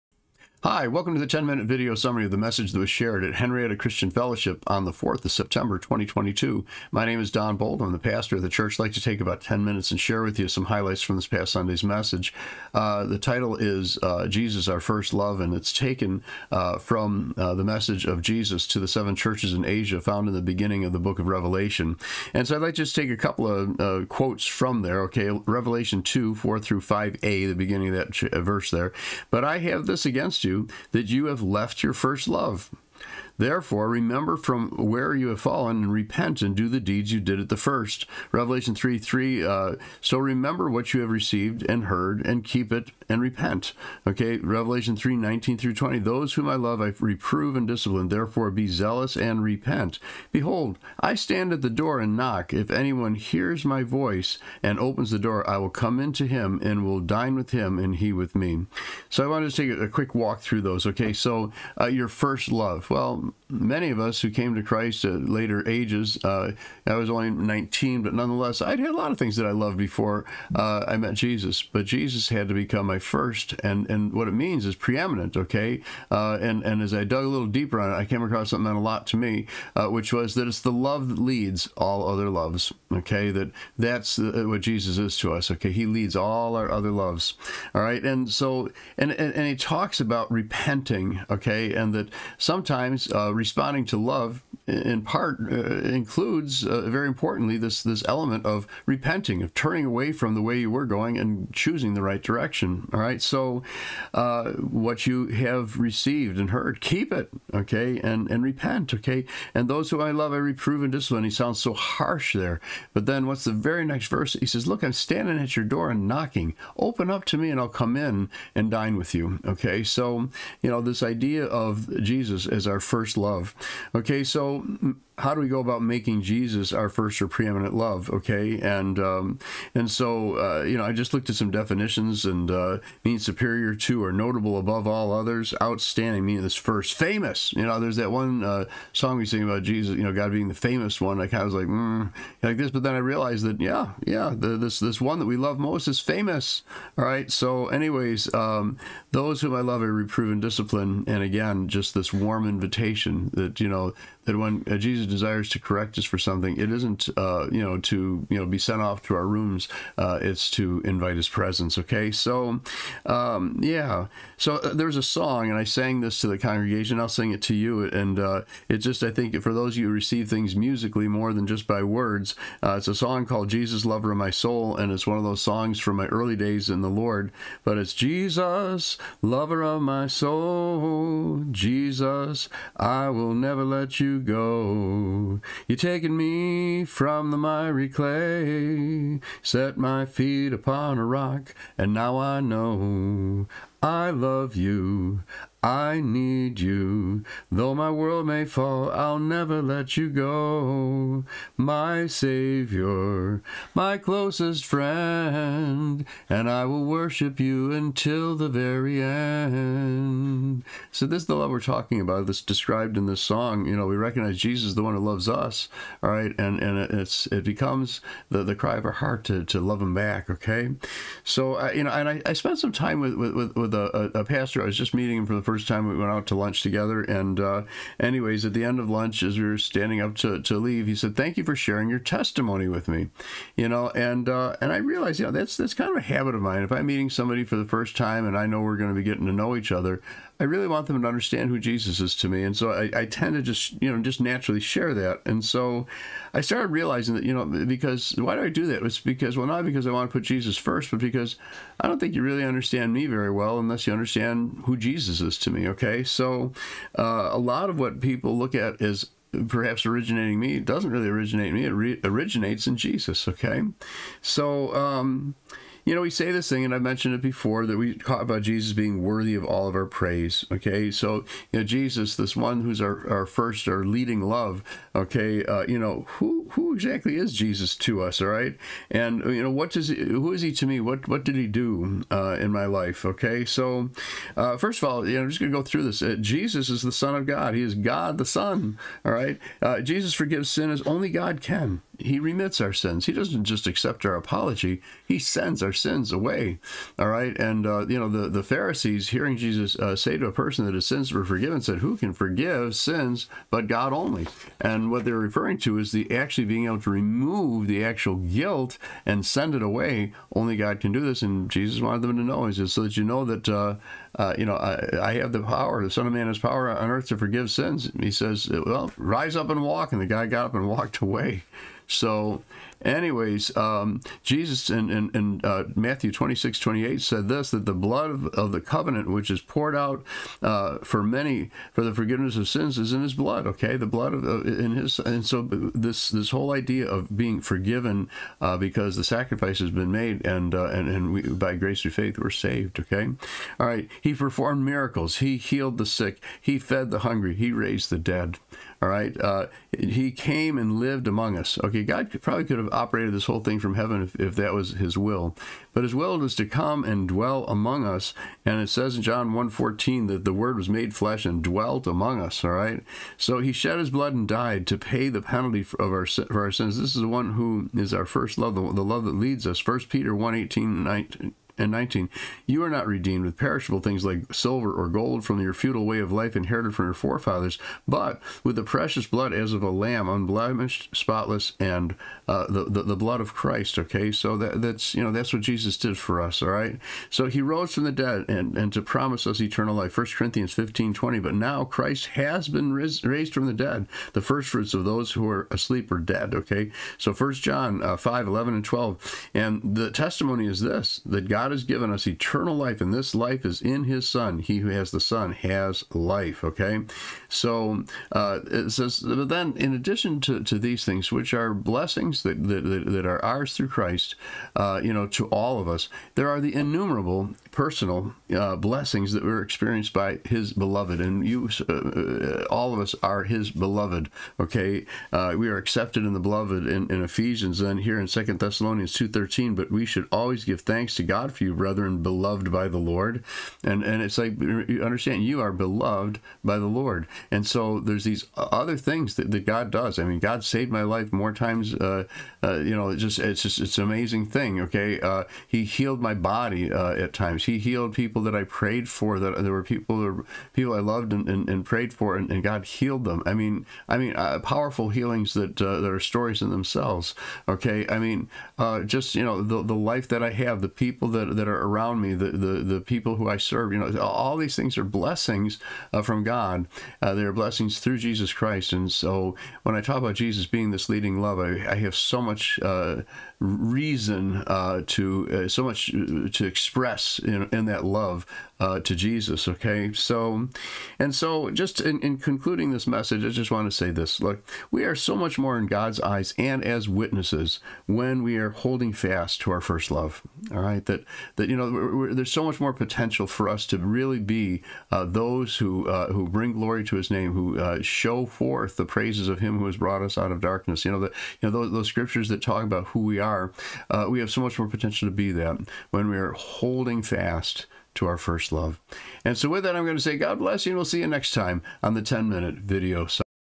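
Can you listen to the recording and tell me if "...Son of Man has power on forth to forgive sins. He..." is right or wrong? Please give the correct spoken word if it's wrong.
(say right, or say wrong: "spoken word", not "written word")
wrong: "earth", not "forth".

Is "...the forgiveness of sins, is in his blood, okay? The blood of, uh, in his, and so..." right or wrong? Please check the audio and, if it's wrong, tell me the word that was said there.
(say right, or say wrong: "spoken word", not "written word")
right.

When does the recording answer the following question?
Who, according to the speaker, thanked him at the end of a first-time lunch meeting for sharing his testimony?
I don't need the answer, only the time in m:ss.
3:44.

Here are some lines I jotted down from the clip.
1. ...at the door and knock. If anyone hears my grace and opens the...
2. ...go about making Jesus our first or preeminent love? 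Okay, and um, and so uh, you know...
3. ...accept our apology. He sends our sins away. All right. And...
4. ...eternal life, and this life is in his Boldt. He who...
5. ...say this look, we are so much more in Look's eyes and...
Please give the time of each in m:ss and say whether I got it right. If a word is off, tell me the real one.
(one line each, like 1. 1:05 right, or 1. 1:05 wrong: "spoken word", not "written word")
1. 0:51 wrong: "voice", not "grace"
2. 2:05 right
3. 4:53 right
4. 6:42 wrong: "Son", not "Boldt"
5. 8:03 wrong: "God", not "Look".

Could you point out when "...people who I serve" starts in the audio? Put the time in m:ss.
7:42.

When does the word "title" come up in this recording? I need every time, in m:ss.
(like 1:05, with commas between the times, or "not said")
0:13.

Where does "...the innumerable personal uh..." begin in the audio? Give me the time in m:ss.
6:56.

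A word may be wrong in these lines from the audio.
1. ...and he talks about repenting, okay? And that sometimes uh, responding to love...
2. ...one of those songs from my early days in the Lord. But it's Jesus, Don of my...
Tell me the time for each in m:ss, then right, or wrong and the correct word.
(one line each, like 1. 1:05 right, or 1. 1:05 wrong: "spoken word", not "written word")
1. 1:29 right
2. 2:55 wrong: "Lover", not "Don".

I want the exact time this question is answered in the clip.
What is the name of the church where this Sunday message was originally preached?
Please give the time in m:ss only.
0:03.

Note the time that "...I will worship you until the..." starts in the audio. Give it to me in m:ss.
3:26.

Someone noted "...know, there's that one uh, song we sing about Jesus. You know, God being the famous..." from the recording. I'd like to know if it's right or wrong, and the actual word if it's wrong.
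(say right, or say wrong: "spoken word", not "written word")
right.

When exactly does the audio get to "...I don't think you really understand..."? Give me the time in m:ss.
4:11.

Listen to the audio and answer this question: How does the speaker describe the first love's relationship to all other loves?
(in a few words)
leads all other loves.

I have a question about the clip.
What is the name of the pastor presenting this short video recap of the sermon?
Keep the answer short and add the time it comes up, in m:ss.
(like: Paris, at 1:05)
Don Boldt, at 0:07.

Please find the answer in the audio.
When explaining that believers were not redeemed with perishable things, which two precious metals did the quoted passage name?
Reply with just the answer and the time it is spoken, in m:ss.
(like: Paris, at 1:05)
silver or gold, at 6:14.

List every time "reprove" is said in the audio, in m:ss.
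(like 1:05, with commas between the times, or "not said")
0:46, 1:50, 2:29.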